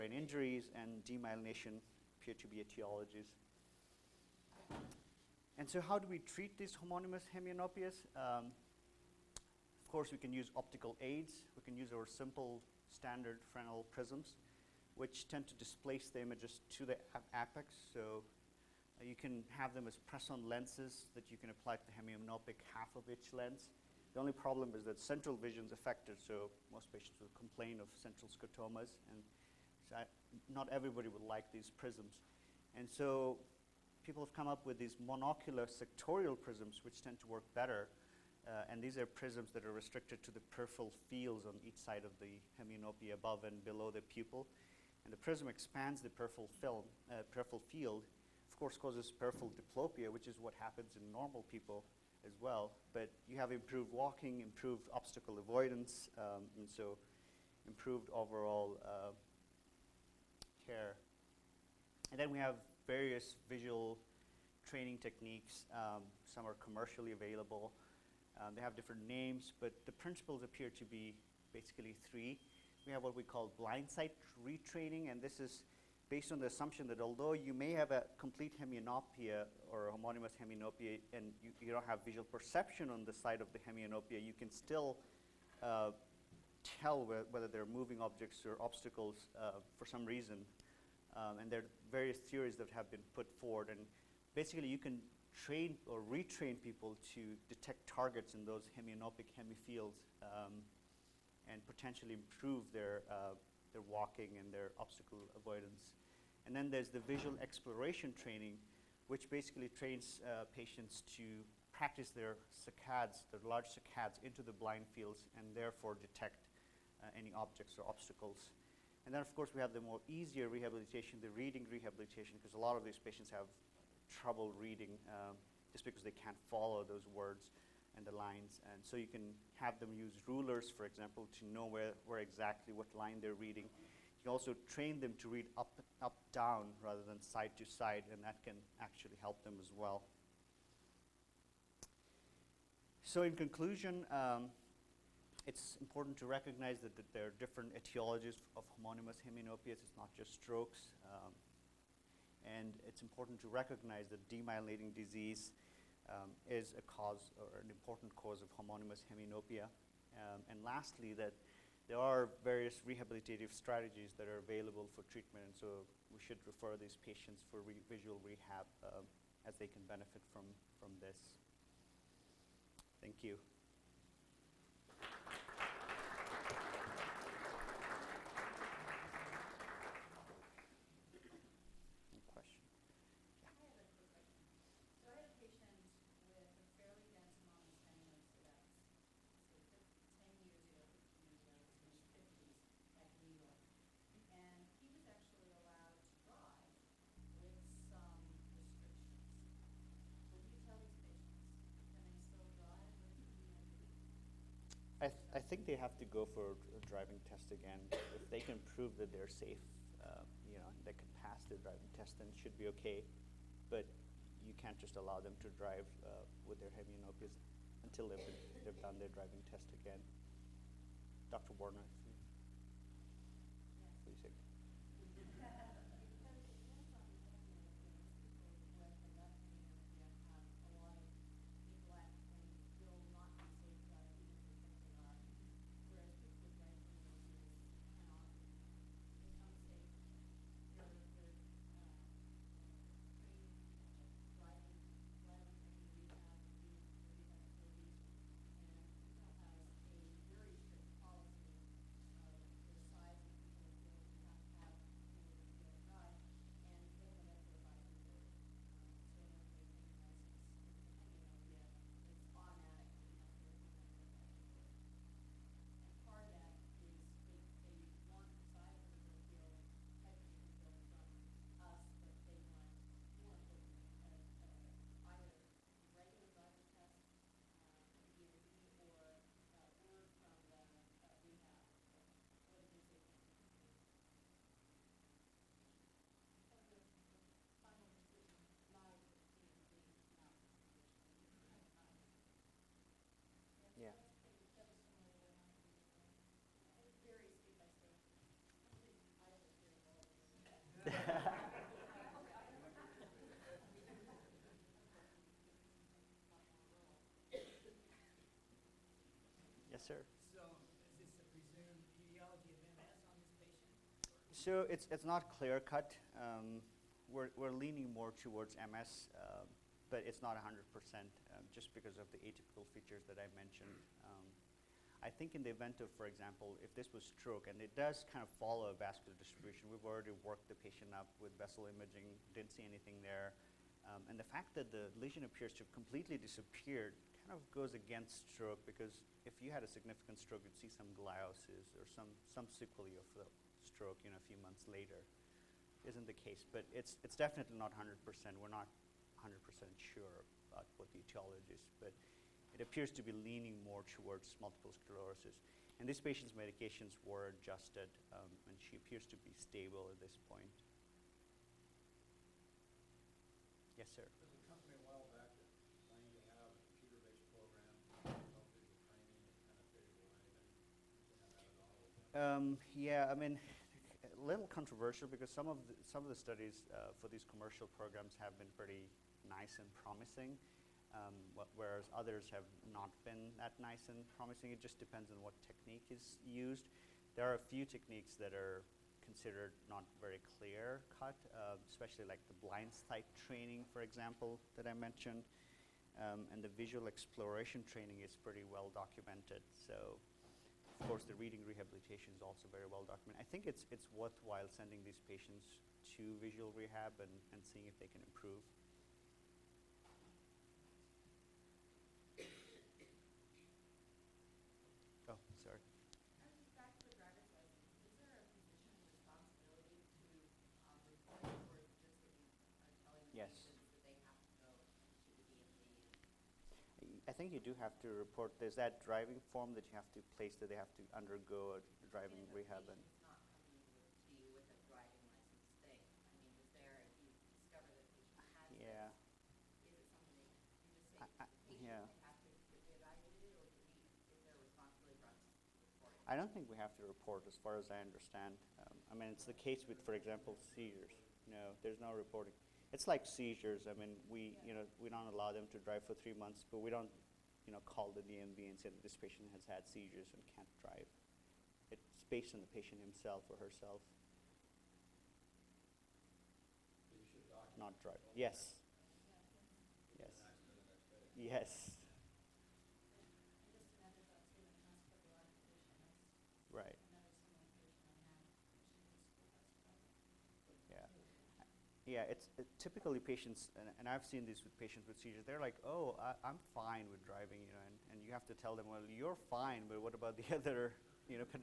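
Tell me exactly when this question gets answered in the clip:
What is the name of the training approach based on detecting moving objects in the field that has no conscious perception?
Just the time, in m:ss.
1:13.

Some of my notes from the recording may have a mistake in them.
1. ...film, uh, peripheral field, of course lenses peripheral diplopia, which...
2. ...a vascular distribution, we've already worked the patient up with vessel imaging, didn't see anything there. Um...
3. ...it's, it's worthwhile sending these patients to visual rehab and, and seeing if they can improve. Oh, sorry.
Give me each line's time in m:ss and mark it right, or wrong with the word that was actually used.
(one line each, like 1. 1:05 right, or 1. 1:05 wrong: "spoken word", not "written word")
1. 0:46 wrong: "causes", not "lenses"
2. 5:28 right
3. 6:43 right.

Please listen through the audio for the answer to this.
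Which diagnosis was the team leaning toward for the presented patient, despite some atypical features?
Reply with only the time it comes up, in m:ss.
5:18.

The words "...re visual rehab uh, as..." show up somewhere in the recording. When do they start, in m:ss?
2:47.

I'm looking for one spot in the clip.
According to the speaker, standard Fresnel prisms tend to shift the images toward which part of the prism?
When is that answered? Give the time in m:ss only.
0:17.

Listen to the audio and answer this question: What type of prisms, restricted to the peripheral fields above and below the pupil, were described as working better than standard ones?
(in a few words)
Monocular sectorial prisms.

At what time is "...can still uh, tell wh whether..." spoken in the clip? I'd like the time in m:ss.
1:24.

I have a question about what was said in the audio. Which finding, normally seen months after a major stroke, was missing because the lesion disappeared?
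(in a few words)
Gliosis.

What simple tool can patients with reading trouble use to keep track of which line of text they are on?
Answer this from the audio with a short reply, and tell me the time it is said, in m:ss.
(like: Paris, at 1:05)
Rulers, at 2:10.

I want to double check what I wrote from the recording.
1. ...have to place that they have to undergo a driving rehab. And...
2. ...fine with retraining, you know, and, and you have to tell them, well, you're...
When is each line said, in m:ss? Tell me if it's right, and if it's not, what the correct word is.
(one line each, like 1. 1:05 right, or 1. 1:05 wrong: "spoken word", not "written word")
1. 7:09 right
2. 8:06 wrong: "driving", not "retraining".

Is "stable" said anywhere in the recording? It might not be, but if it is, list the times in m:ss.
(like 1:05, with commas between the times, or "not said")
5:59.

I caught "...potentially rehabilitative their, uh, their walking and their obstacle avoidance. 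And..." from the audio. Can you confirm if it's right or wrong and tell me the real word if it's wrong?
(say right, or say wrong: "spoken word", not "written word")
wrong: "improve", not "rehabilitative".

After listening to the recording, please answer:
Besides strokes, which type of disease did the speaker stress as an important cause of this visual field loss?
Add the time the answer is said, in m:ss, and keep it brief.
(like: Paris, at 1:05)
Demyelinating disease, at 2:34.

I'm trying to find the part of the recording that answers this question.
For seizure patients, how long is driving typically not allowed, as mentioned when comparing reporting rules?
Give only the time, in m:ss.
7:36.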